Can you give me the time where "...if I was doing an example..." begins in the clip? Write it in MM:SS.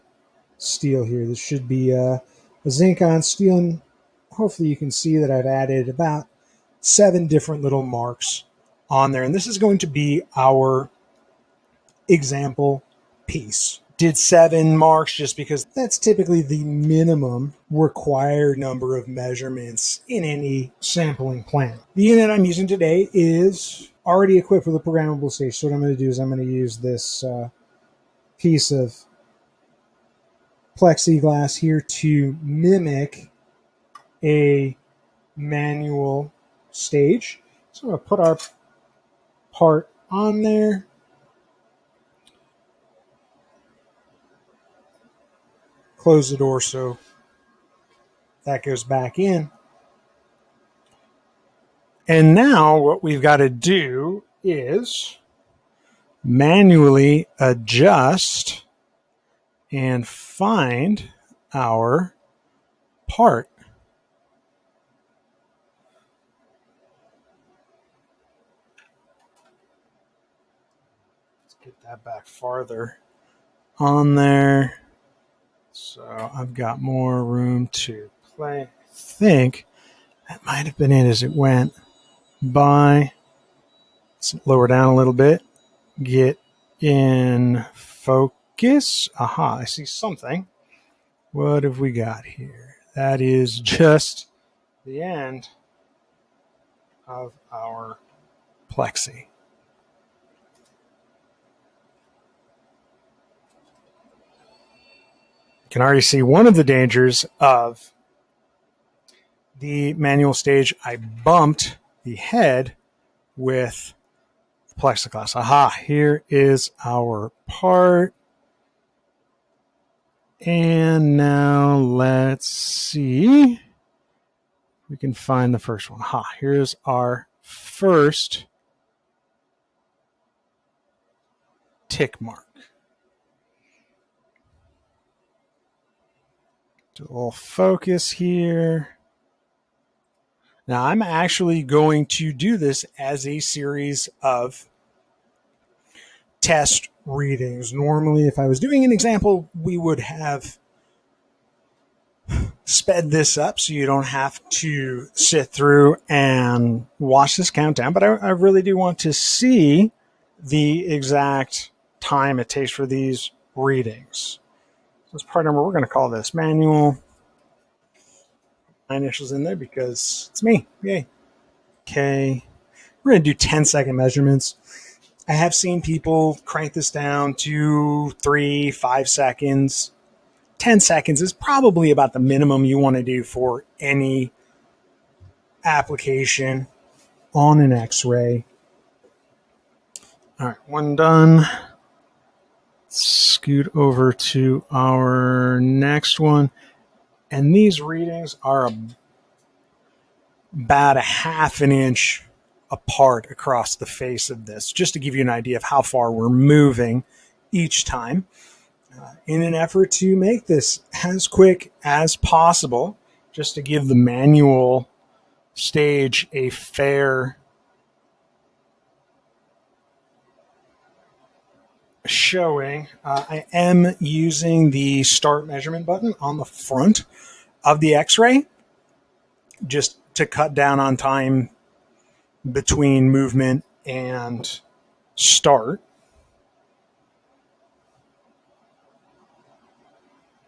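02:28.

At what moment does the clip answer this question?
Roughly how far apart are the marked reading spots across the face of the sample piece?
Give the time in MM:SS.
03:20.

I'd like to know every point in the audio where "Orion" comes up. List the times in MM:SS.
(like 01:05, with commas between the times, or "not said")
not said.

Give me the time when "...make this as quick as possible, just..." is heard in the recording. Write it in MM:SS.
03:30.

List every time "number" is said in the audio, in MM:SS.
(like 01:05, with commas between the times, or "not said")
00:18, 02:45.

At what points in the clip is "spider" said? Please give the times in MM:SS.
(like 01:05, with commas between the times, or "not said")
not said.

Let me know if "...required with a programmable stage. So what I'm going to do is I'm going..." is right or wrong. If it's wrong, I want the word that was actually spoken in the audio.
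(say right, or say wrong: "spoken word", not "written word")
wrong: "equipped", not "required".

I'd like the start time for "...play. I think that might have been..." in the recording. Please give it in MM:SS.
01:18.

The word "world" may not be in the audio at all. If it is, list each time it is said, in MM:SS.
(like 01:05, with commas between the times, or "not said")
not said.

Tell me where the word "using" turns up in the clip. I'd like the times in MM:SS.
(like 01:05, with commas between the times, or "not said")
00:22, 03:43.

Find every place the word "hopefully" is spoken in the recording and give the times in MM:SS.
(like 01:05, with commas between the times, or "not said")
00:04.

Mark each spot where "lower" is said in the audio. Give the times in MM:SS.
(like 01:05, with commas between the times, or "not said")
01:24.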